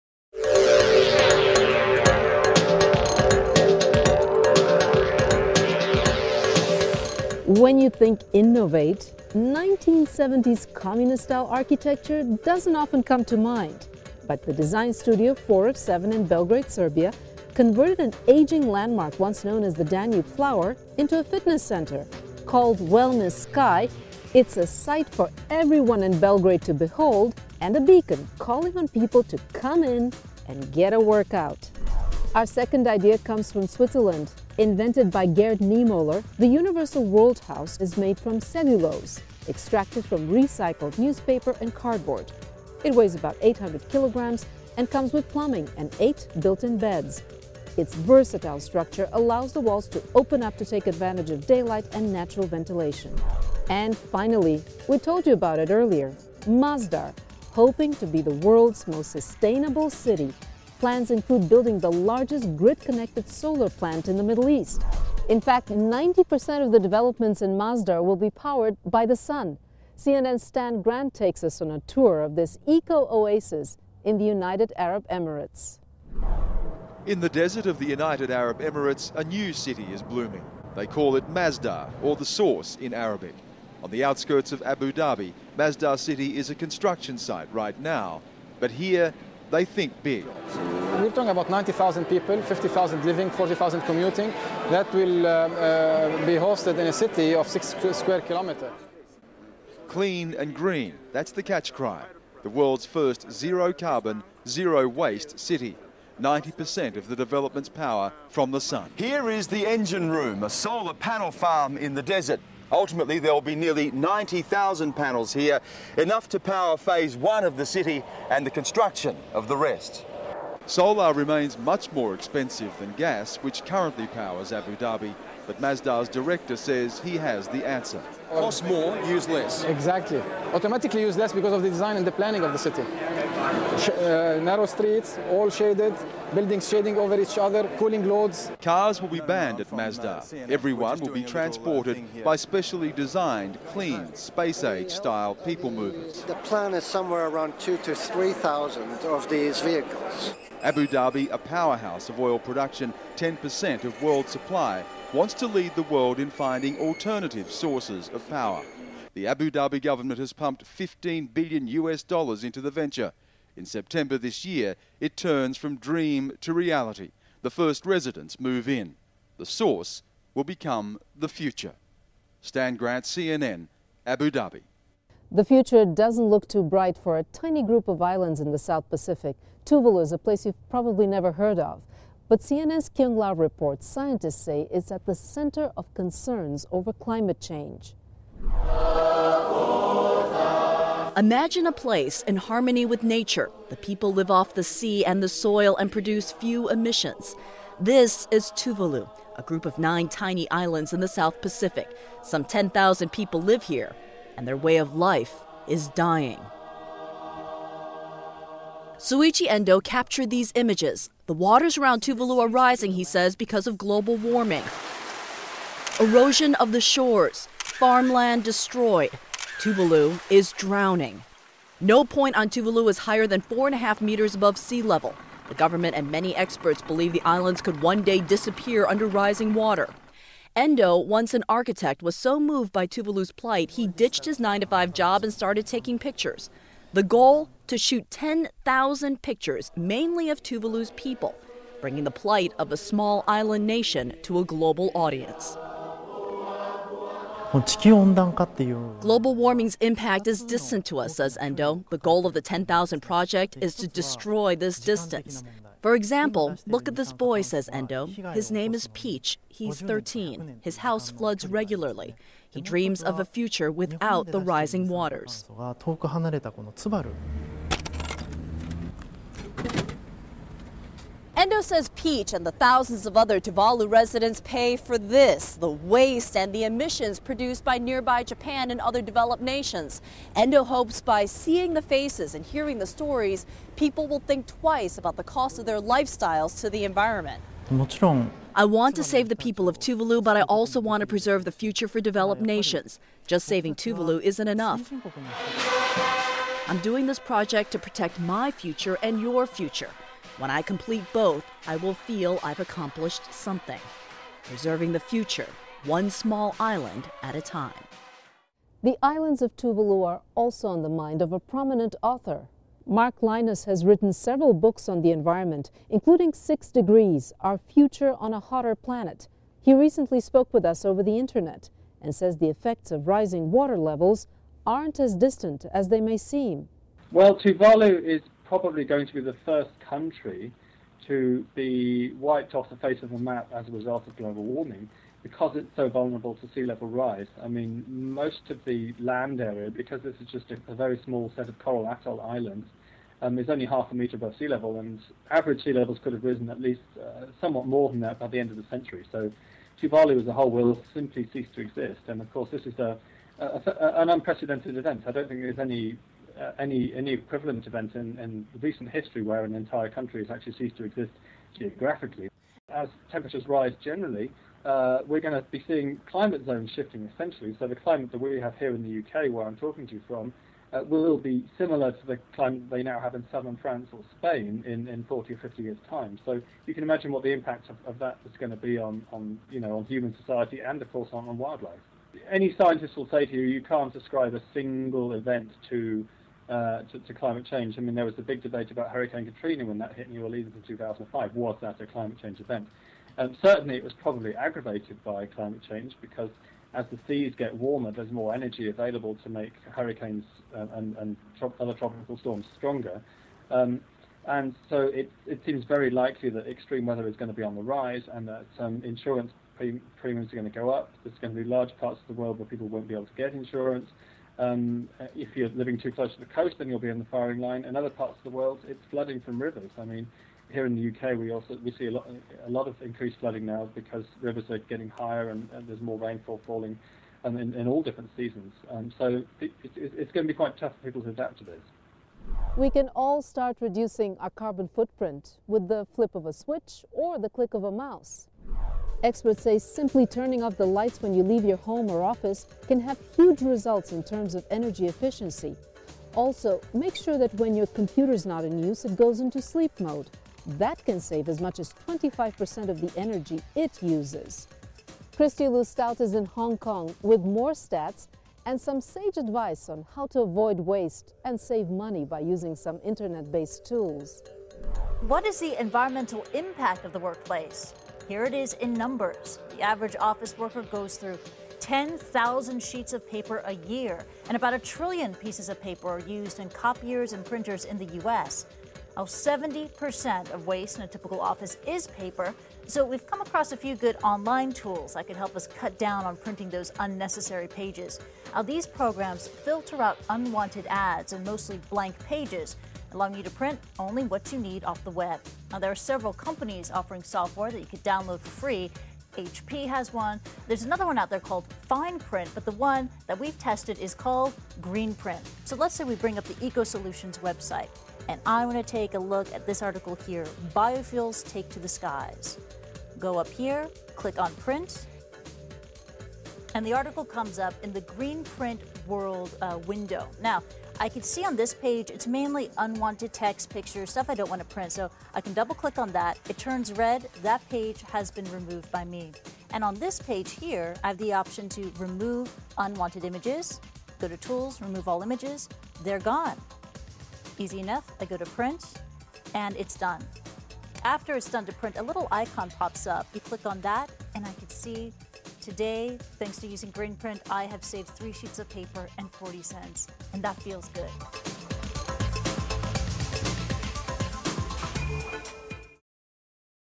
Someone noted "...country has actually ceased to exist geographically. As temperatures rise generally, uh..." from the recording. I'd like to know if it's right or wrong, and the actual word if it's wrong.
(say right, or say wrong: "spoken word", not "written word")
right.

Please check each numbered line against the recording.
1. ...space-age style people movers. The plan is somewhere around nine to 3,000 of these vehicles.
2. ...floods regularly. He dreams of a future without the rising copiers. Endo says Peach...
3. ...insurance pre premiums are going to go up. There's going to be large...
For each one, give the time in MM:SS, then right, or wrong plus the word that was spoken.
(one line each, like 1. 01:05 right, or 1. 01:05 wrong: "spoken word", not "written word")
1. 02:24 wrong: "two", not "nine"
2. 04:21 wrong: "waters", not "copiers"
3. 06:48 right.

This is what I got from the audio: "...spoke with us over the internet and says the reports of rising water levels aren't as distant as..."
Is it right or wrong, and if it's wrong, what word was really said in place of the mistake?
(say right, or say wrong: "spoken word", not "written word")
wrong: "effects", not "reports".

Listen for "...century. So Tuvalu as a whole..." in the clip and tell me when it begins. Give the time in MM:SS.
05:48.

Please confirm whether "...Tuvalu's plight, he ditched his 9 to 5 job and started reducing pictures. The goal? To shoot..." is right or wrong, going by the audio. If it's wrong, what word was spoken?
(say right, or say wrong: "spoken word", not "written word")
wrong: "taking", not "reducing".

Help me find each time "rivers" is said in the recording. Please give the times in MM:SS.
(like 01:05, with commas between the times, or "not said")
06:59, 07:04.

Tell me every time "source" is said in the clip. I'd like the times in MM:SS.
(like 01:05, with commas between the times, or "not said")
01:22, 02:37, 02:49.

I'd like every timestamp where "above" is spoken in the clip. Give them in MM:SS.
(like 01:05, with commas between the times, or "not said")
03:44, 05:44.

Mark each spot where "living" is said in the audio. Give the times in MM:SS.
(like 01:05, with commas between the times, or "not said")
01:33, 06:55.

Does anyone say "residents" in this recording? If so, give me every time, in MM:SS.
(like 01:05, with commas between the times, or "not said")
02:47, 04:33.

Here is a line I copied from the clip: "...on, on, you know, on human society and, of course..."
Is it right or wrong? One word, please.
right.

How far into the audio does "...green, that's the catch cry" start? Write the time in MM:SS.
01:40.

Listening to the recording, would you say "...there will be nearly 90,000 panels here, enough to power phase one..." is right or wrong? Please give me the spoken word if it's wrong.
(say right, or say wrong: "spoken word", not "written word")
right.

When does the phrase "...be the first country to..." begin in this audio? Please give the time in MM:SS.
05:29.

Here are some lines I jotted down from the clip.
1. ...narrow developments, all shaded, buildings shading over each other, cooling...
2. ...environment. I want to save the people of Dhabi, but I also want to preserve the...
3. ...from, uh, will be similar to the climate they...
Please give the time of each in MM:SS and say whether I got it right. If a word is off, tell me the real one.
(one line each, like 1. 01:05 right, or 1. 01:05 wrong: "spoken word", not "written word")
1. 02:14 wrong: "streets", not "developments"
2. 04:46 wrong: "Tuvalu", not "Dhabi"
3. 06:10 right.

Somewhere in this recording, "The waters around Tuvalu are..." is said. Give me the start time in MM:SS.
03:31.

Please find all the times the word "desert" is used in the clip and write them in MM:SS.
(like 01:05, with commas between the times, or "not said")
01:17, 01:52.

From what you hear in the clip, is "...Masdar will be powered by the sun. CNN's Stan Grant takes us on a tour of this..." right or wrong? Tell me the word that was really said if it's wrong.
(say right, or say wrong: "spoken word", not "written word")
right.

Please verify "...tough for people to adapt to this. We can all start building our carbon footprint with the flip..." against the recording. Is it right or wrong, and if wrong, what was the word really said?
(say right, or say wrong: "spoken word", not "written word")
wrong: "reducing", not "building".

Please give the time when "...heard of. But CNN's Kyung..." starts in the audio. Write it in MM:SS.
03:01.